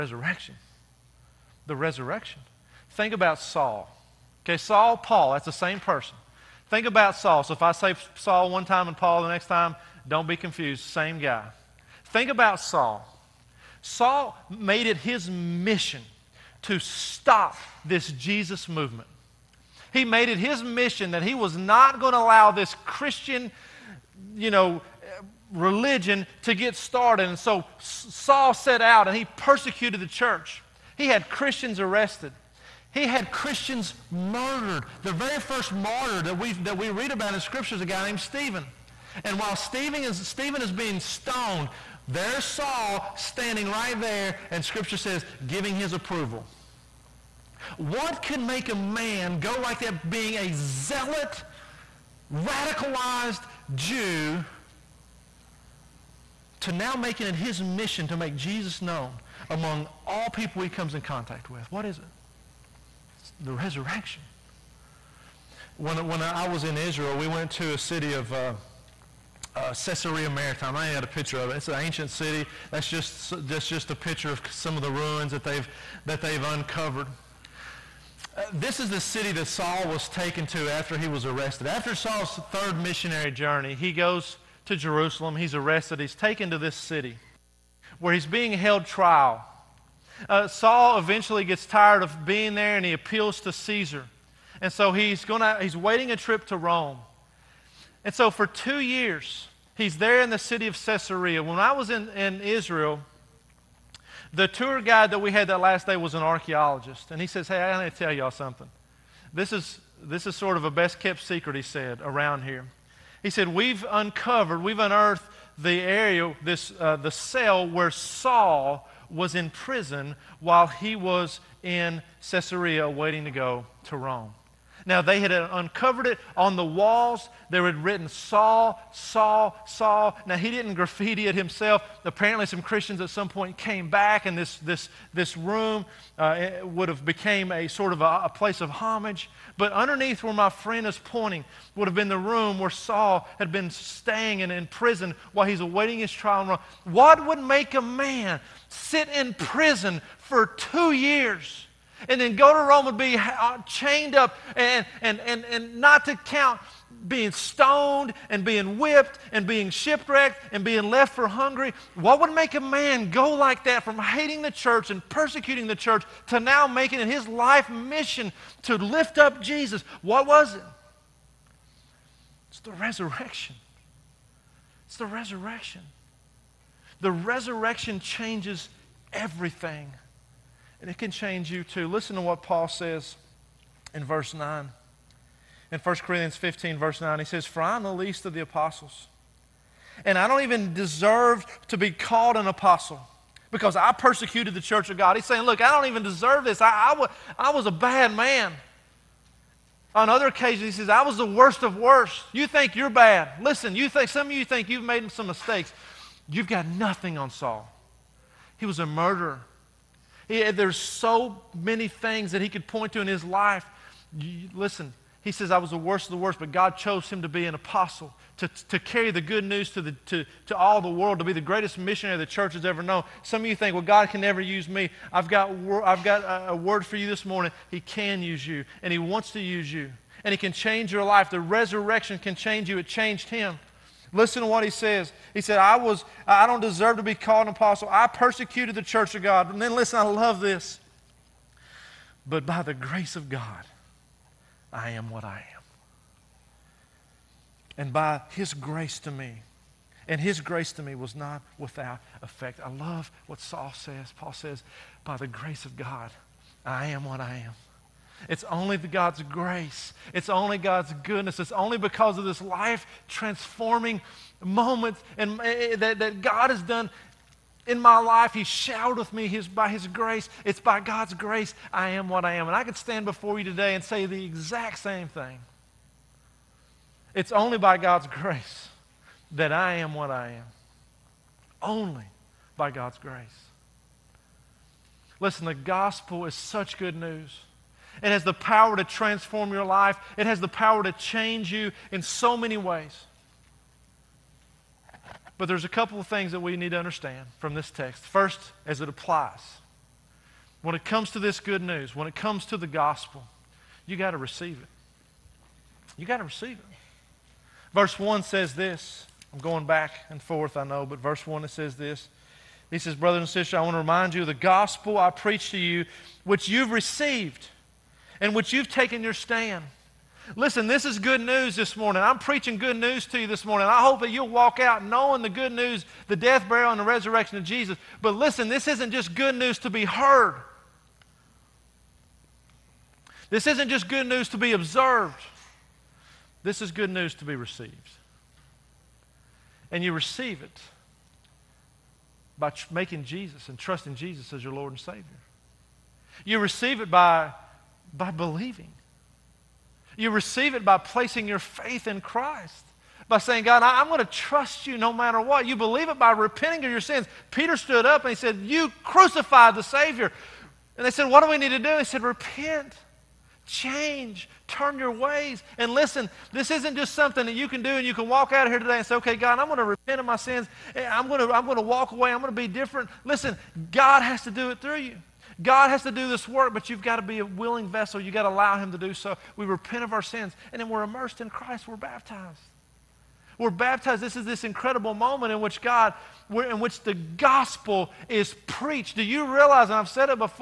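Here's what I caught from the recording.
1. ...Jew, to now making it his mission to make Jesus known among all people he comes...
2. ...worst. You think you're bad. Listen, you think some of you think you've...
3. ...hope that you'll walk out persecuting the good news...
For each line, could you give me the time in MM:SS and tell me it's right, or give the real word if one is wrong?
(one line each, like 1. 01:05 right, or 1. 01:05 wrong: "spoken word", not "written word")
1. 00:53 right
2. 03:21 right
3. 05:23 wrong: "knowing", not "persecuting".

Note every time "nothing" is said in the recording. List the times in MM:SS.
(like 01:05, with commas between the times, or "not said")
03:26.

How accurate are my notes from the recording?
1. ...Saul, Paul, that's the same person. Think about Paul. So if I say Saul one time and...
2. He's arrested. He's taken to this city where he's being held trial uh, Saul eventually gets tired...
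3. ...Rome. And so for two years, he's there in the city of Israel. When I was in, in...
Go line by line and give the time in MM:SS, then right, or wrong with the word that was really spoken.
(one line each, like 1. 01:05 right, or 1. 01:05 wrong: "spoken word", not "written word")
1. 00:04 wrong: "Saul", not "Paul"
2. 01:25 right
3. 01:36 wrong: "Caesarea", not "Israel".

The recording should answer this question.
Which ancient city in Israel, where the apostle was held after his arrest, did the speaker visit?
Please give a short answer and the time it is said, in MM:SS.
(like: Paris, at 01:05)
Caesarea Maritime, at 01:09.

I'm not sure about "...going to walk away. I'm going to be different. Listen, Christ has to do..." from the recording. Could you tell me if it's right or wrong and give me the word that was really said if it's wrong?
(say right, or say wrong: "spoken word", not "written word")
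wrong: "God", not "Christ".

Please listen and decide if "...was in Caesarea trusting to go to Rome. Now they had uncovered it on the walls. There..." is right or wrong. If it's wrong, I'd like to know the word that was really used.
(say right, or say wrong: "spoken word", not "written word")
wrong: "waiting", not "trusting".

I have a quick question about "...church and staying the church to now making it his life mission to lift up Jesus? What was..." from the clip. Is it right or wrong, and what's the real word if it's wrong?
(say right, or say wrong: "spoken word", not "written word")
wrong: "persecuting", not "staying".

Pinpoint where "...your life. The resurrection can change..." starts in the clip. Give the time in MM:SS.
03:50.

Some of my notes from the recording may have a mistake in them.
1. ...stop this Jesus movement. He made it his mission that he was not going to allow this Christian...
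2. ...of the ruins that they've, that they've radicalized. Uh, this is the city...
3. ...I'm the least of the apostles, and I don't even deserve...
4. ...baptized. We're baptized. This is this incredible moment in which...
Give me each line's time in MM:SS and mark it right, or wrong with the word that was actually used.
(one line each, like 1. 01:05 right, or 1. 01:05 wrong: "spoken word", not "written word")
1. 00:16 right
2. 01:14 wrong: "uncovered", not "radicalized"
3. 03:07 right
4. 06:21 right.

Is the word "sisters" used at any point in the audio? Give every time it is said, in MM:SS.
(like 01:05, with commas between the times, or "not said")
05:13.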